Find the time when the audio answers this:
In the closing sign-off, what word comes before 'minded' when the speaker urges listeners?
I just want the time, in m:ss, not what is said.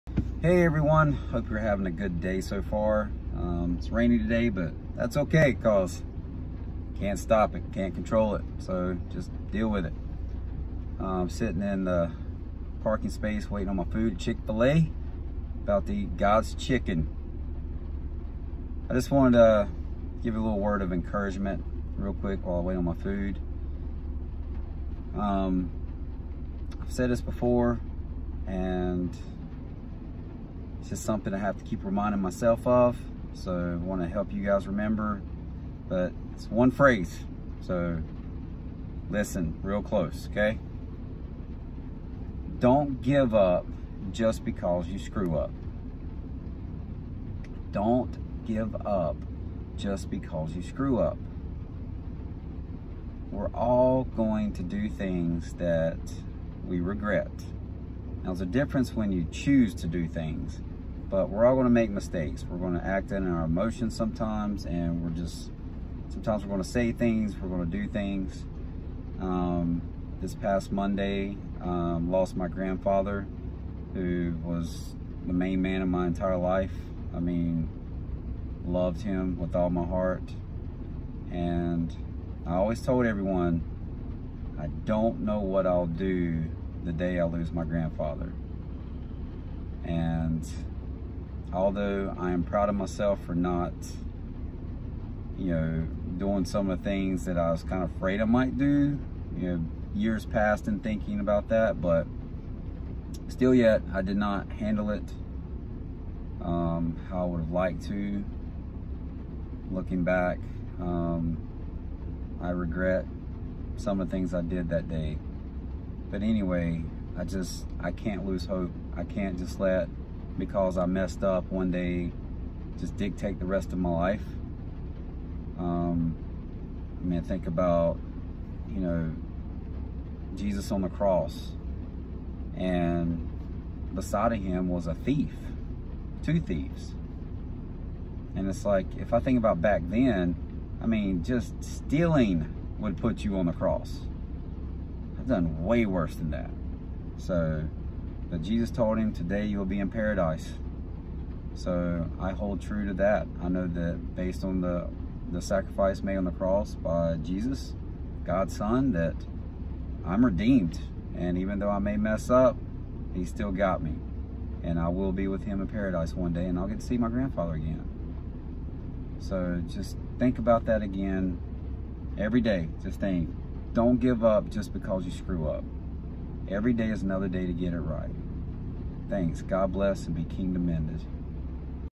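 3:00.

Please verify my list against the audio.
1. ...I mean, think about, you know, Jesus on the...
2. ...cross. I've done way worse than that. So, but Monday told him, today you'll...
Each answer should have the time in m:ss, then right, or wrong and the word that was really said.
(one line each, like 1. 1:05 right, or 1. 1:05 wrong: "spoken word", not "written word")
1. 2:06 right
2. 2:23 wrong: "Jesus", not "Monday".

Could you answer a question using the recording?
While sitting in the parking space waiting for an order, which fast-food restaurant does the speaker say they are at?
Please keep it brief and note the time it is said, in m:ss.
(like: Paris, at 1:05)
Chick-fil-A, at 0:14.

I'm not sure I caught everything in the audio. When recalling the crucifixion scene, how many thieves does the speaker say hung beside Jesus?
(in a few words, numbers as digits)
2.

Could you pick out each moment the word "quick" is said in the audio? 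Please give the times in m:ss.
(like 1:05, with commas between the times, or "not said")
0:22.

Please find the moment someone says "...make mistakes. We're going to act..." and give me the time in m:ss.
1:01.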